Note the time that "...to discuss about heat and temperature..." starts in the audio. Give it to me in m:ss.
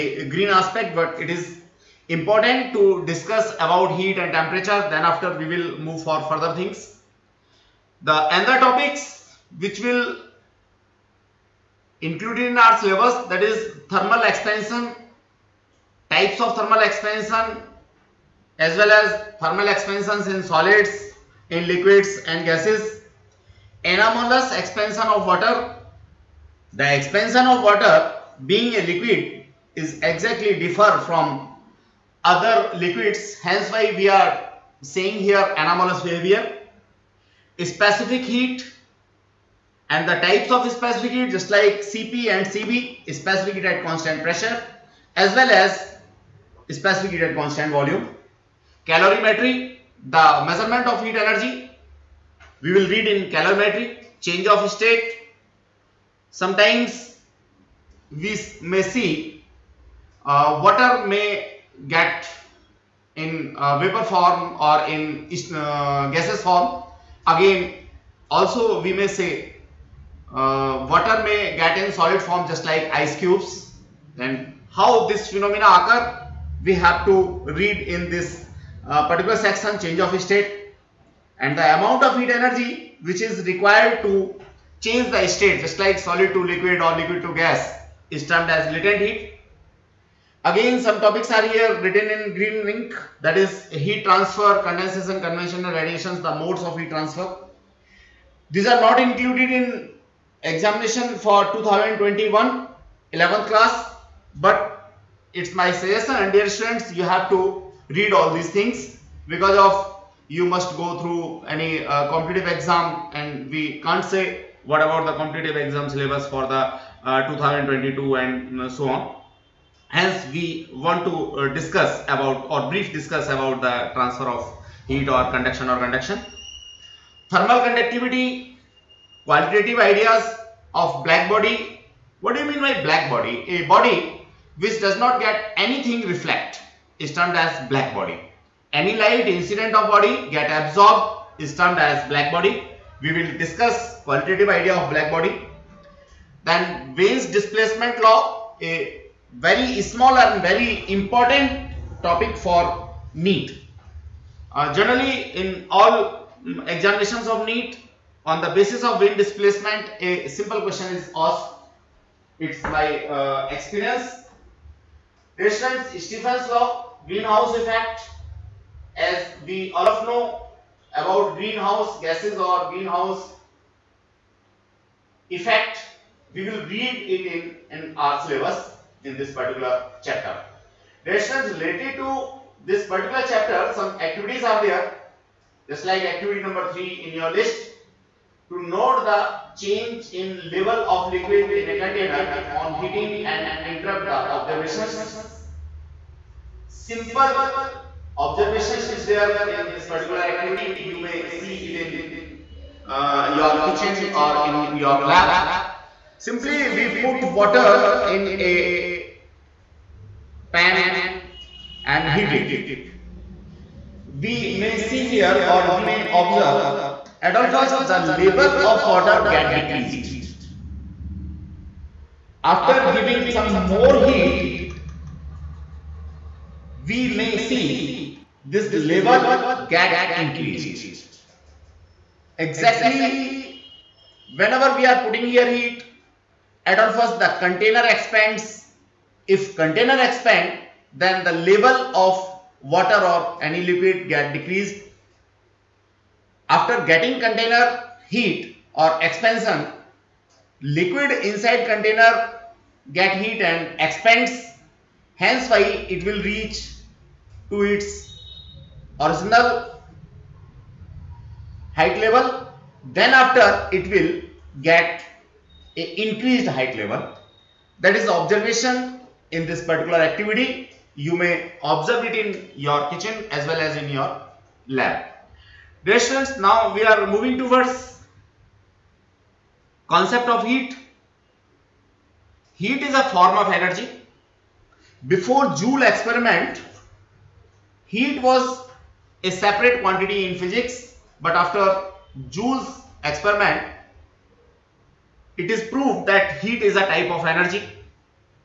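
0:02.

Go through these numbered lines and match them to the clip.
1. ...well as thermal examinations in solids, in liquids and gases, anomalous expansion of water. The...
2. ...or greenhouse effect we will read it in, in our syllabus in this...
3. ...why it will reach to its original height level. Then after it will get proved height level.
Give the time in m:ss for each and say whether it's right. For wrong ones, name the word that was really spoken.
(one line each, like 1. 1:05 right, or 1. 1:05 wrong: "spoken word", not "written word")
1. 0:18 wrong: "expansions", not "examinations"
2. 2:52 right
3. 4:15 wrong: "increased", not "proved".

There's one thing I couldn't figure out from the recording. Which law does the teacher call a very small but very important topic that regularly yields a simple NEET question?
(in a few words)
Wien's displacement law.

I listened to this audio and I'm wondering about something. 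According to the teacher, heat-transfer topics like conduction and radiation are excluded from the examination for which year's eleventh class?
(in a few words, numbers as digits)
2021.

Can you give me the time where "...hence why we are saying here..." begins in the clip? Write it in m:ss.
0:33.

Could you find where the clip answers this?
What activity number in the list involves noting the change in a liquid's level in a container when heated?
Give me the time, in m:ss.
3:06.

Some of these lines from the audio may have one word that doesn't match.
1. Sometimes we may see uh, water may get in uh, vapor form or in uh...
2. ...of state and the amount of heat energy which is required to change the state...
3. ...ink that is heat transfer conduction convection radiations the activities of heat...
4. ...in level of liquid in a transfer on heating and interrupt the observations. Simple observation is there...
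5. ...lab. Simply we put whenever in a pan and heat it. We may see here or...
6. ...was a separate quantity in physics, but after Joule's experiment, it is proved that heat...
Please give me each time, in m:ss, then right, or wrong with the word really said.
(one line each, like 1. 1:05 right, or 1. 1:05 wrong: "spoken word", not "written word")
1. 0:56 right
2. 1:19 right
3. 1:32 wrong: "modes", not "activities"
4. 3:10 wrong: "container", not "transfer"
5. 3:25 wrong: "water", not "whenever"
6. 4:48 right.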